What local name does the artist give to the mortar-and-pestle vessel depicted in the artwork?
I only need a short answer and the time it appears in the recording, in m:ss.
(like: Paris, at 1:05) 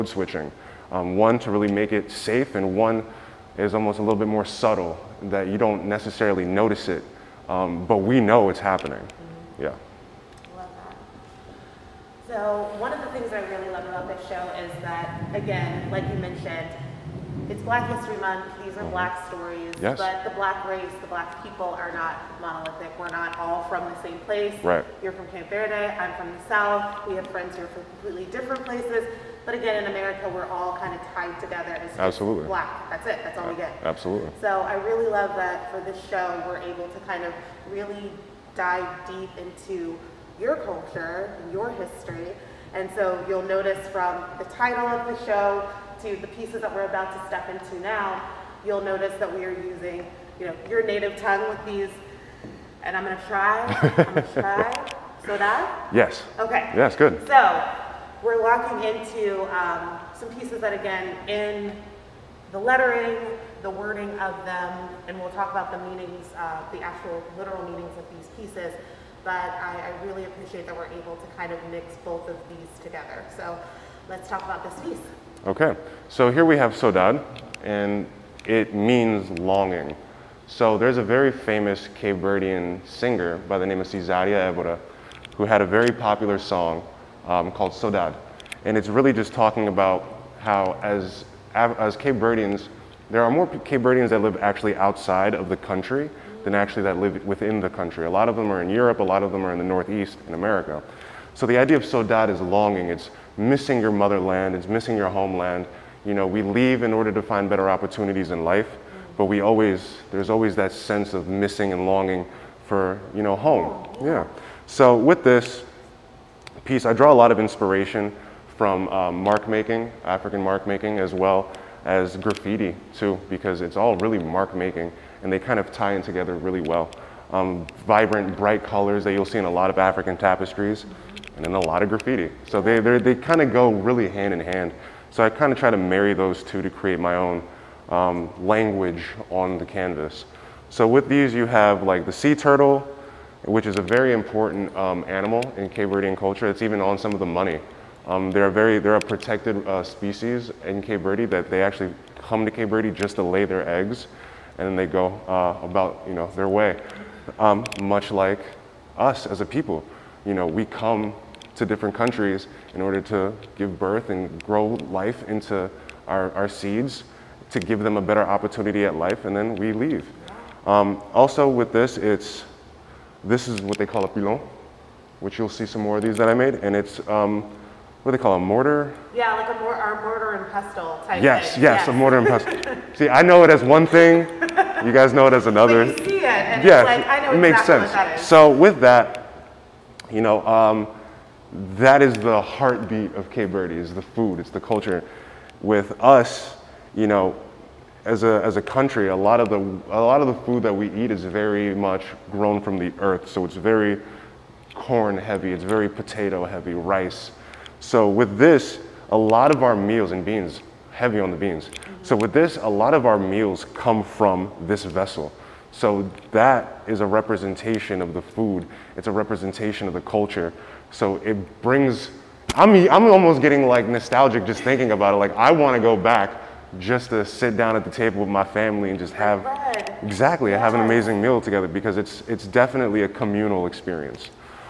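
Pilon, at 2:54.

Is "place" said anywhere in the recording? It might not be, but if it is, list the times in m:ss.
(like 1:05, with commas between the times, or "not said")
0:24, 0:28.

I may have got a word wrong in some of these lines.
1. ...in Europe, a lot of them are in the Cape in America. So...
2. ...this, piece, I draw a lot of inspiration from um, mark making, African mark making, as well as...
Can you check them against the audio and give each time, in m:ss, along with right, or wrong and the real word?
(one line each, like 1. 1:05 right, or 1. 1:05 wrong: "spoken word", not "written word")
1. 1:38 wrong: "Northeast", not "Cape"
2. 1:55 right.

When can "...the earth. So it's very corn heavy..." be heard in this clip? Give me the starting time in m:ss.
3:22.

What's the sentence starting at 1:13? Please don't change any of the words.
So let's talk about this piece.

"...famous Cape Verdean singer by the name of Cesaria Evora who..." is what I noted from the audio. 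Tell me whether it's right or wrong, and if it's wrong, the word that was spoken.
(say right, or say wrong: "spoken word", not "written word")
right.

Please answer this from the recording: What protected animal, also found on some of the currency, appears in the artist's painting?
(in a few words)
Sea turtle.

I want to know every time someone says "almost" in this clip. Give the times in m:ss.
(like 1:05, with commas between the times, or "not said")
0:03, 3:43.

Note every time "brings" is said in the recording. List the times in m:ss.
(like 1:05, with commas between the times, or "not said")
3:41.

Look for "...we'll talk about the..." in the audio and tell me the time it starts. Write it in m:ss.
1:05.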